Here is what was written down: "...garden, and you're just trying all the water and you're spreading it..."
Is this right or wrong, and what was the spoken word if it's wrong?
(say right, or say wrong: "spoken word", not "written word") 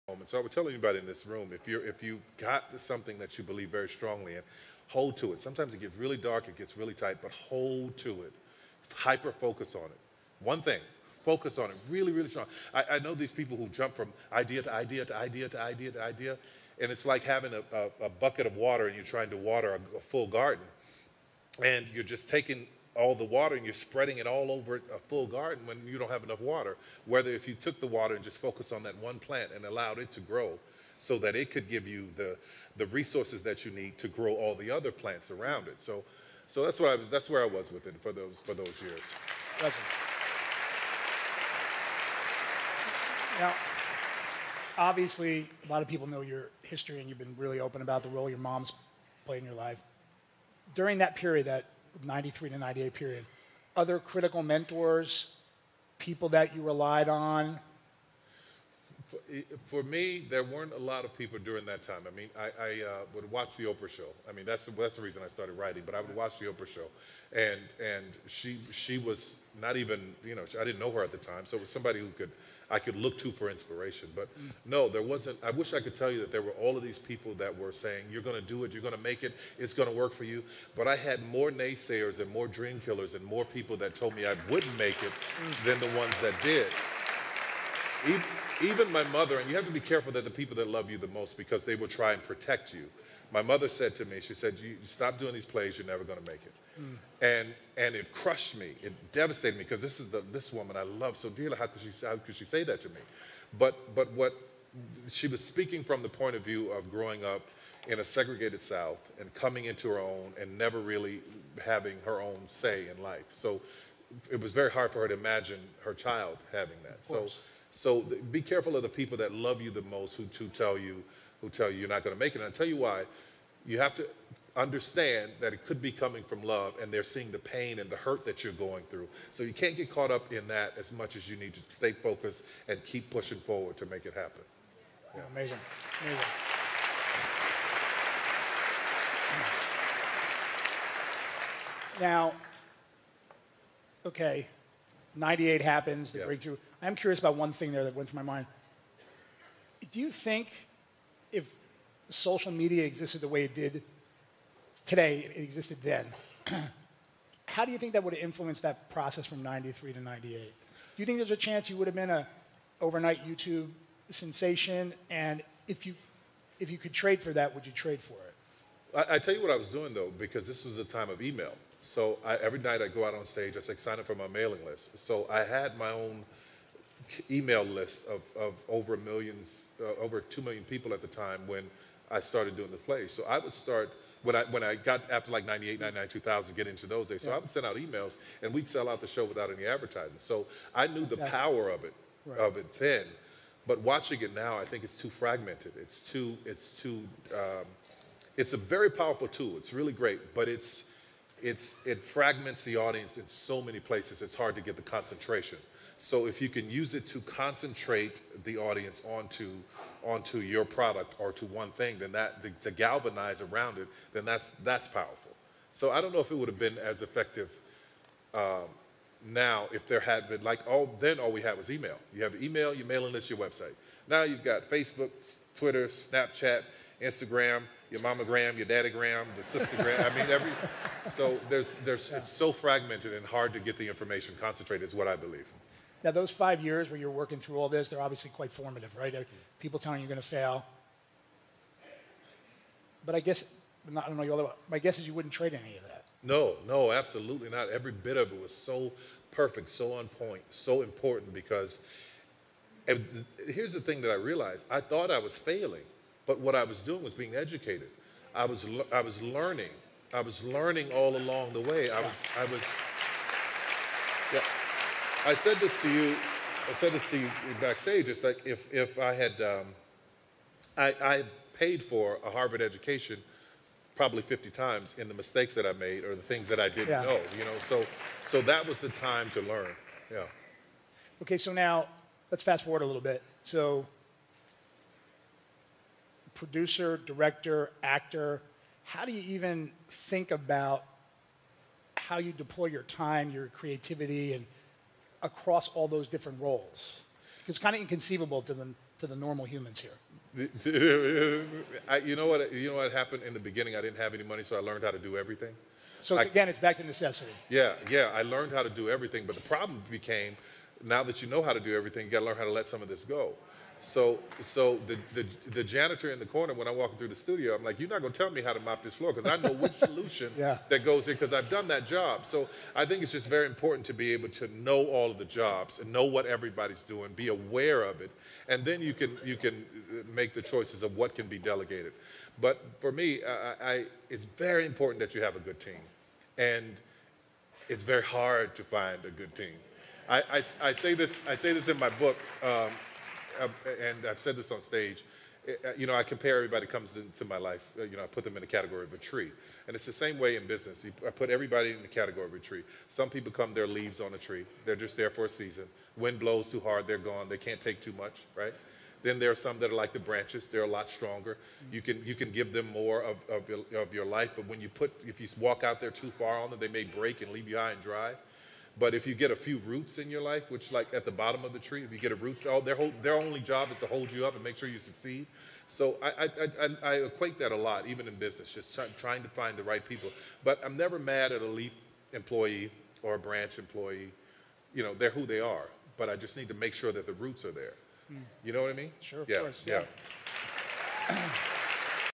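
wrong: "taking", not "trying".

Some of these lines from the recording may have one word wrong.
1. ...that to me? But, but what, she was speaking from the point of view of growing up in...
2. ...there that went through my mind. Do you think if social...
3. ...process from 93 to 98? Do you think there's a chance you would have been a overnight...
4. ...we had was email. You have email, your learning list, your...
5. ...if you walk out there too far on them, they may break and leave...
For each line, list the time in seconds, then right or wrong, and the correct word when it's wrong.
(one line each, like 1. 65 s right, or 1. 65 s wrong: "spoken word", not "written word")
1. 102 s right
2. 147 s right
3. 158 s right
4. 221 s wrong: "mailing", not "learning"
5. 365 s right.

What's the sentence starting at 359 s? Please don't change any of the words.
Then there are some that are like the branches.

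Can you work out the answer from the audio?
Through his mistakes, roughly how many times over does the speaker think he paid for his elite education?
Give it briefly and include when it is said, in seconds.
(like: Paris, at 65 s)
50, at 274 s.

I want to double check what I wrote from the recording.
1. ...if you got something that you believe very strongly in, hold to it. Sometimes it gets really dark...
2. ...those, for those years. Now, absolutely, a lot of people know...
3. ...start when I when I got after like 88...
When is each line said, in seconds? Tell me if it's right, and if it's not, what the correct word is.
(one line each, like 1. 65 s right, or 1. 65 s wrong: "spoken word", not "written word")
1. 1 s right
2. 38 s wrong: "obviously", not "absolutely"
3. 183 s wrong: "98", not "88".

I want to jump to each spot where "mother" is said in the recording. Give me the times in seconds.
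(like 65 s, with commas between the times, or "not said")
89 s, 93 s.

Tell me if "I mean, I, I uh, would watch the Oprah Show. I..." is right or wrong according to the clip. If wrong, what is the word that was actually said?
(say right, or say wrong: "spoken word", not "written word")
right.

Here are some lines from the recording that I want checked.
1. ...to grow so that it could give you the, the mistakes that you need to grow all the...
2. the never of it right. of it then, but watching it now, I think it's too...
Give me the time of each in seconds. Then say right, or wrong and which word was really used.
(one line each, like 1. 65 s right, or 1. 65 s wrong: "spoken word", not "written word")
1. 30 s wrong: "resources", not "mistakes"
2. 191 s wrong: "power", not "never".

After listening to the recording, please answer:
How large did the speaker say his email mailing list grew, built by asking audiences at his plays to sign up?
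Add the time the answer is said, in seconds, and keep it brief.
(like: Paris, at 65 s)
over 2 million people, at 180 s.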